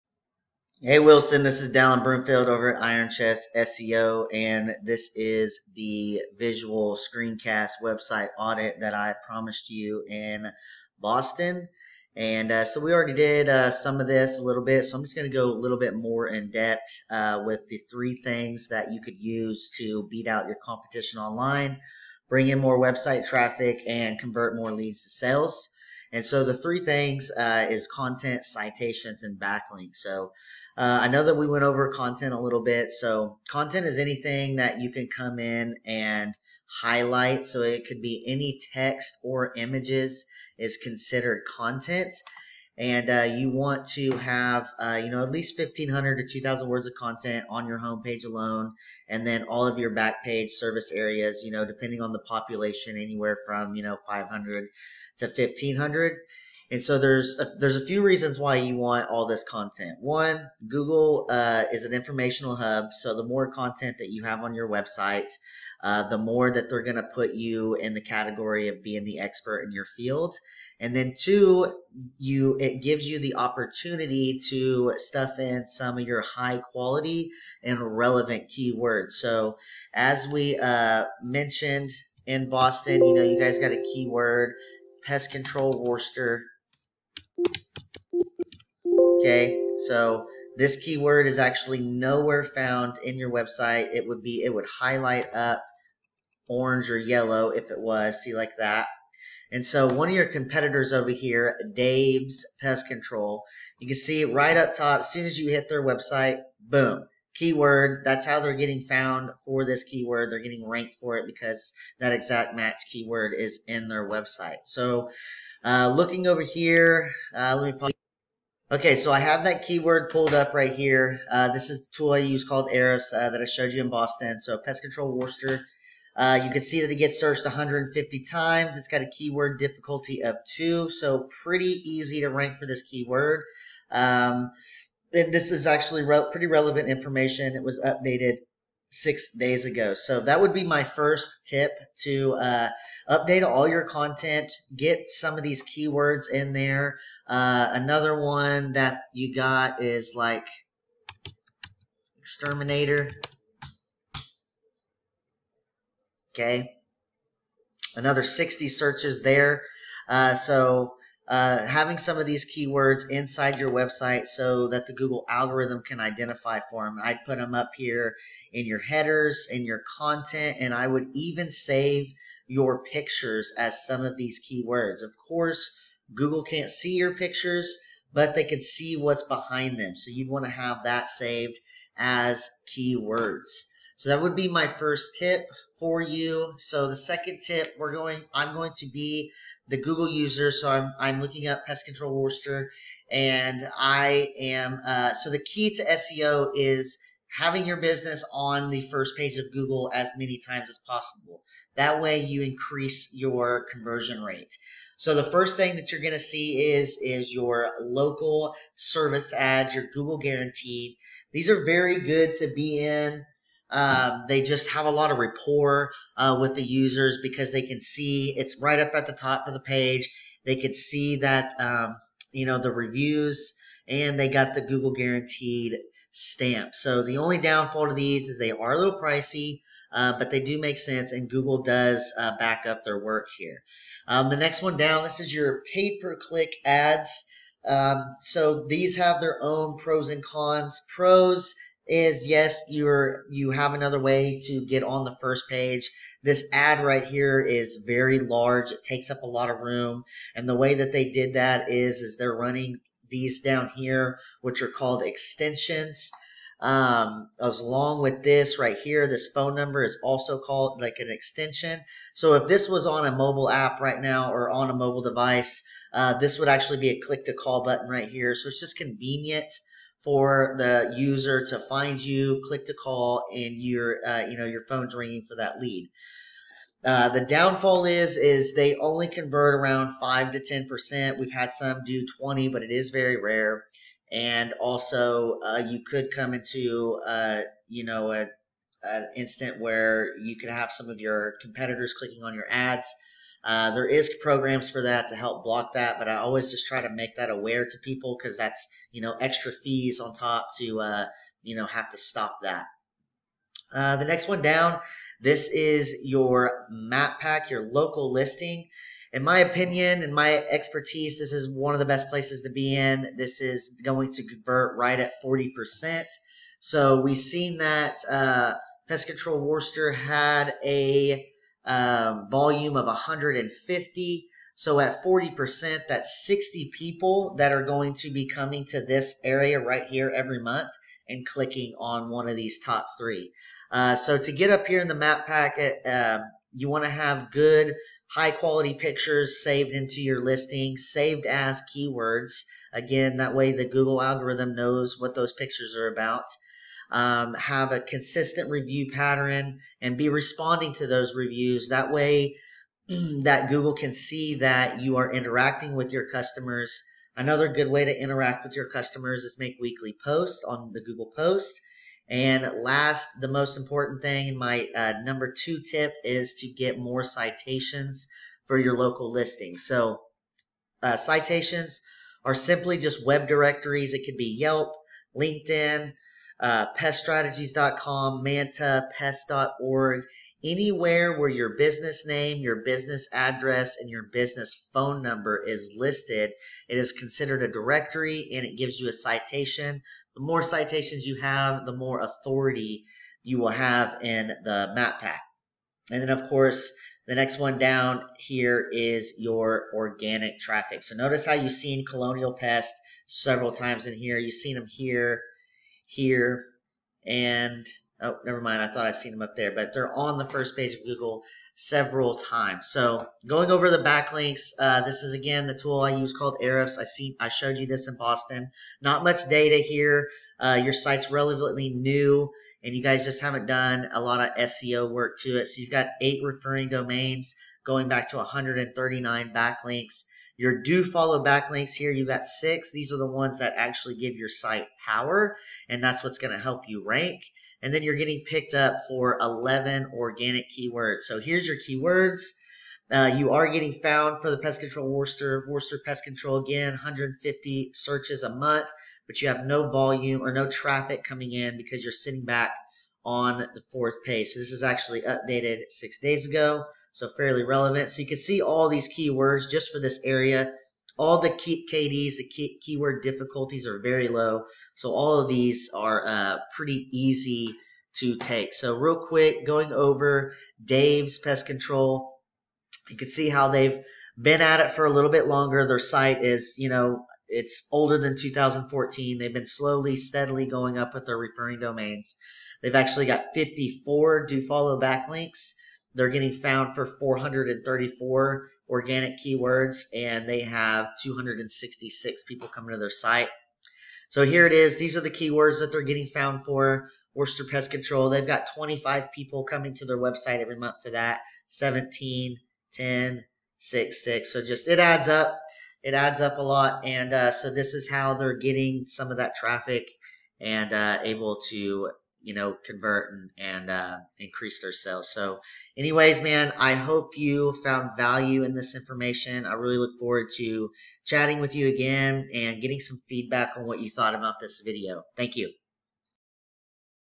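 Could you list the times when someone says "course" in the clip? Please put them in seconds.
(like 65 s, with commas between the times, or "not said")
175 s, 396 s.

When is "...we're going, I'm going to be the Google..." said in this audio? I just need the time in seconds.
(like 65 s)
187 s.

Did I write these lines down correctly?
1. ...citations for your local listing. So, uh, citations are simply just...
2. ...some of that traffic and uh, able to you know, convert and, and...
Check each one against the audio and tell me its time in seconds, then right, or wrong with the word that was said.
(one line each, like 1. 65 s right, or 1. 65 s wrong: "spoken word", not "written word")
1. 367 s right
2. 508 s right.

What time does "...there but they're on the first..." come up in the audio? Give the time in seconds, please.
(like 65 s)
409 s.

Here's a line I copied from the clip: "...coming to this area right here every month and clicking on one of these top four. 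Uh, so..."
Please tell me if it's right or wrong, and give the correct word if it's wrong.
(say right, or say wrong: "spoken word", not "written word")
wrong: "three", not "four".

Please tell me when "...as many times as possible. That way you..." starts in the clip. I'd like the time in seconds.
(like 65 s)
199 s.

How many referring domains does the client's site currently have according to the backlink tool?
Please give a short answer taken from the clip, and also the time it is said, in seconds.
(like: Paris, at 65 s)
8, at 425 s.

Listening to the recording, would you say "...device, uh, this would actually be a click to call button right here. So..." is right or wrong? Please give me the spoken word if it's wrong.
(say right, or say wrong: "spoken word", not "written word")
right.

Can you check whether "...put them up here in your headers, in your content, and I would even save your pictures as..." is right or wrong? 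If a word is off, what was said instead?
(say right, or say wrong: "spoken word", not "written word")
right.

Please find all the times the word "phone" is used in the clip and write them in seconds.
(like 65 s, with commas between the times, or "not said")
259 s, 274 s, 384 s.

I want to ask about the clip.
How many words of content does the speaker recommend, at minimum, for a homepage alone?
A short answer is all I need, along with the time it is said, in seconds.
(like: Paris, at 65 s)
1,500 to 2,000, at 45 s.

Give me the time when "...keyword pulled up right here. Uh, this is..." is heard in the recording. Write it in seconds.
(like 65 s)
119 s.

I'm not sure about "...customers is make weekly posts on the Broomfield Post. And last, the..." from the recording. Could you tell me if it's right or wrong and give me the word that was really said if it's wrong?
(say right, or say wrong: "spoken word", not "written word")
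wrong: "Google", not "Broomfield".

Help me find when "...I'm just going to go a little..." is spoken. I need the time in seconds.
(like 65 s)
14 s.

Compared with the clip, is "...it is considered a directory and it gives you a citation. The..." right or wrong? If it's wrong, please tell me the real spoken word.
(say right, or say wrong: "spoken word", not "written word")
right.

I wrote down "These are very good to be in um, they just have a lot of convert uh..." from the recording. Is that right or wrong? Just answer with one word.
wrong.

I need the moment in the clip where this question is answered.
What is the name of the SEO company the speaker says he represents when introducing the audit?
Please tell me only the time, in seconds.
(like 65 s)
2 s.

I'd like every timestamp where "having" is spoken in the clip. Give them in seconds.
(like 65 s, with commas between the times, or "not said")
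161 s, 197 s.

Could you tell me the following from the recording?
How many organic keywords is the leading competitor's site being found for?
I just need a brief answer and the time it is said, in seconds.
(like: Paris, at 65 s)
434, at 486 s.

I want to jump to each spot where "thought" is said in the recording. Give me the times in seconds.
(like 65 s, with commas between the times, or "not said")
408 s, 523 s.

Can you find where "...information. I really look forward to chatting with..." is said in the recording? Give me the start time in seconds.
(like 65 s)
518 s.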